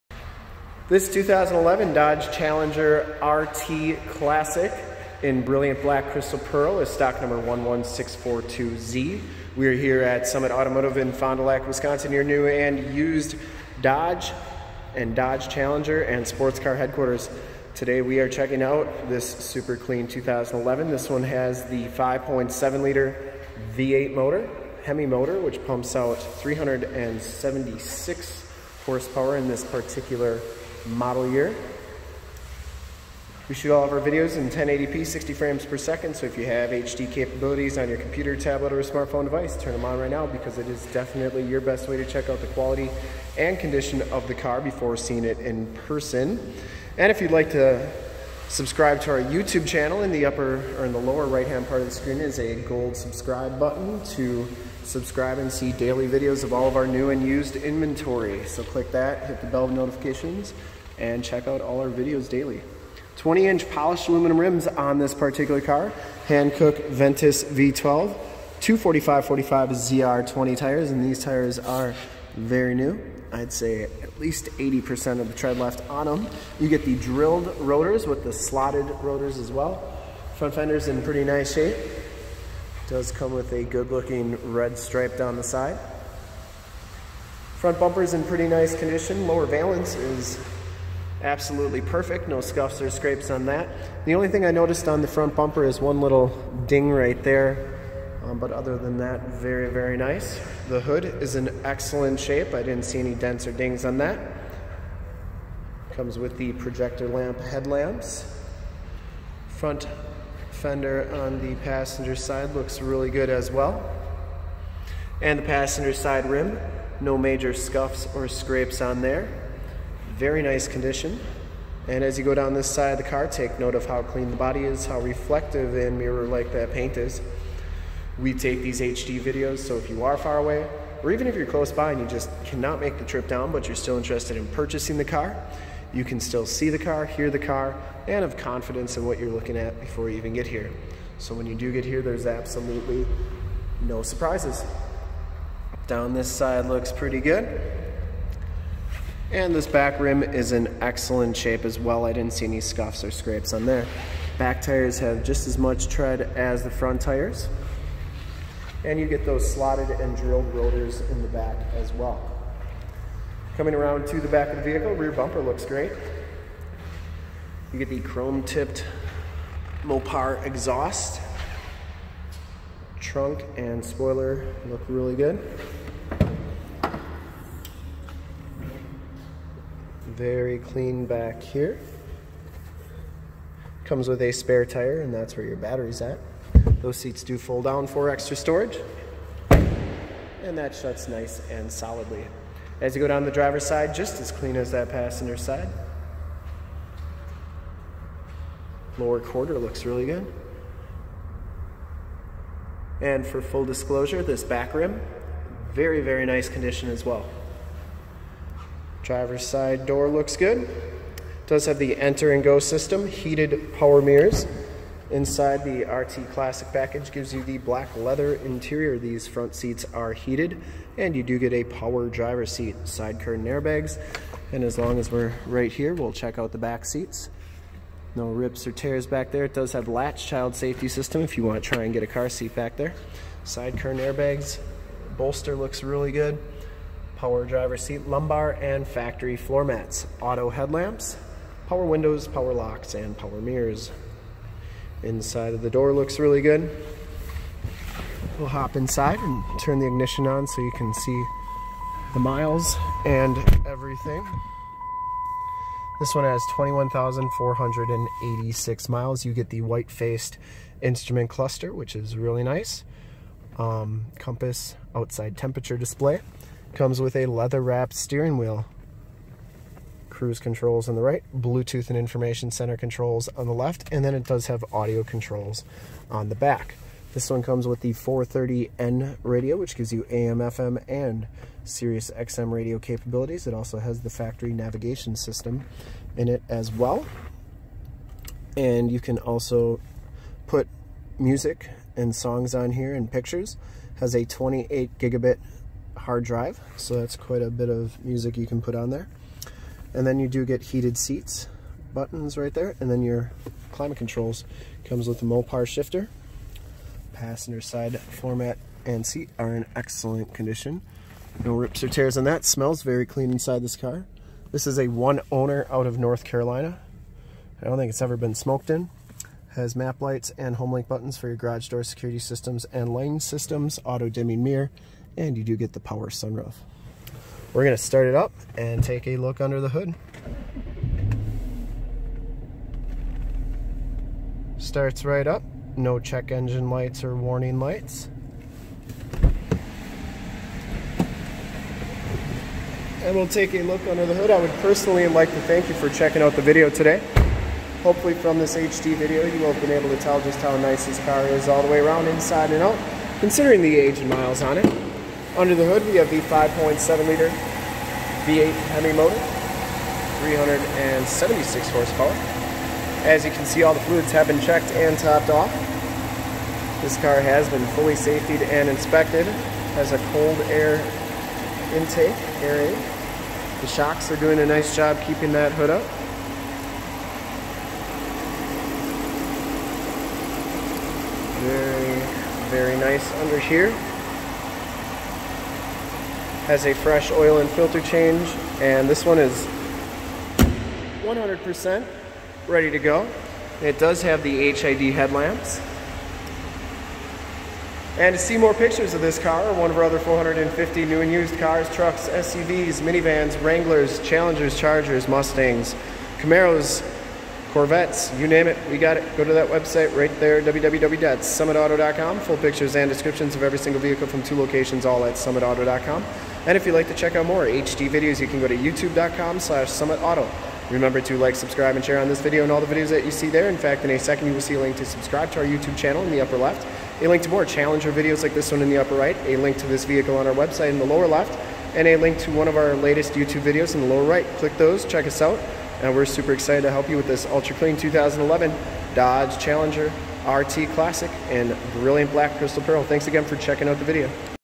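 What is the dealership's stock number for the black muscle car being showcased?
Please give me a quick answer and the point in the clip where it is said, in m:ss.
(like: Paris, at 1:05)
11642Z, at 0:07.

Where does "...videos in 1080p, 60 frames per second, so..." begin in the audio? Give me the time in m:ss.
0:33.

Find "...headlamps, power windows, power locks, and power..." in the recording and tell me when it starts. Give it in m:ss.
4:00.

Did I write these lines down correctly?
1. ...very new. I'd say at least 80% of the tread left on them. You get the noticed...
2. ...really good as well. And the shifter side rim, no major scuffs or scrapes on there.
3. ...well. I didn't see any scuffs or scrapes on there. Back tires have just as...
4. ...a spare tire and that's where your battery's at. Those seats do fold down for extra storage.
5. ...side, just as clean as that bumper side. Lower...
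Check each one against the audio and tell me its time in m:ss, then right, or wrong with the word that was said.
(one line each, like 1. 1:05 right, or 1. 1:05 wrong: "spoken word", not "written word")
1. 1:12 wrong: "drilled", not "noticed"
2. 1:52 wrong: "passenger", not "shifter"
3. 2:31 right
4. 3:04 right
5. 3:13 wrong: "passenger", not "bumper".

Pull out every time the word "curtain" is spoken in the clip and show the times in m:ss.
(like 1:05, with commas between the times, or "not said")
3:43, 3:53.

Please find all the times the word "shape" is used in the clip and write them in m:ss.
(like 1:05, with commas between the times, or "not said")
1:21, 1:42, 2:31.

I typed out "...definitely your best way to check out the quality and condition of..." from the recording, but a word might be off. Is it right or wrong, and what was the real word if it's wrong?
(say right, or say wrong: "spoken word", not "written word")
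right.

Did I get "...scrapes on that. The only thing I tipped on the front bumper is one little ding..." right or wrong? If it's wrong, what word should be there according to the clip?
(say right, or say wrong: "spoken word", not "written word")
wrong: "noticed", not "tipped".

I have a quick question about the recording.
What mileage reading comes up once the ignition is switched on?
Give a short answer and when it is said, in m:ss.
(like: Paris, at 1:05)
21,486, at 4:16.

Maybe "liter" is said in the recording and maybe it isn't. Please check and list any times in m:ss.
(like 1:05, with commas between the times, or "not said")
0:22, 5:57.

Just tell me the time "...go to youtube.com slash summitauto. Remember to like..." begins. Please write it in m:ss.
6:58.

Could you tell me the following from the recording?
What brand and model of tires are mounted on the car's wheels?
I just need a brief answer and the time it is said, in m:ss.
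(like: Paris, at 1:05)
Hankook Ventus V12, at 1:06.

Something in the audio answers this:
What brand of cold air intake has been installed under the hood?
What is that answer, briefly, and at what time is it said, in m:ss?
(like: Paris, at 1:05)
Airaid, at 6:12.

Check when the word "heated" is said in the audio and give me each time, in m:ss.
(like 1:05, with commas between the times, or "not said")
3:33, 3:40, 5:00.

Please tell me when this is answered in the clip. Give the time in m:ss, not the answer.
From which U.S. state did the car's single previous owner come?
5:15.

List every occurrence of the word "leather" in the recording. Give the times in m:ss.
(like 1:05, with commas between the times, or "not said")
3:37, 4:27.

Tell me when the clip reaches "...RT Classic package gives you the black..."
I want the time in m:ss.
3:35.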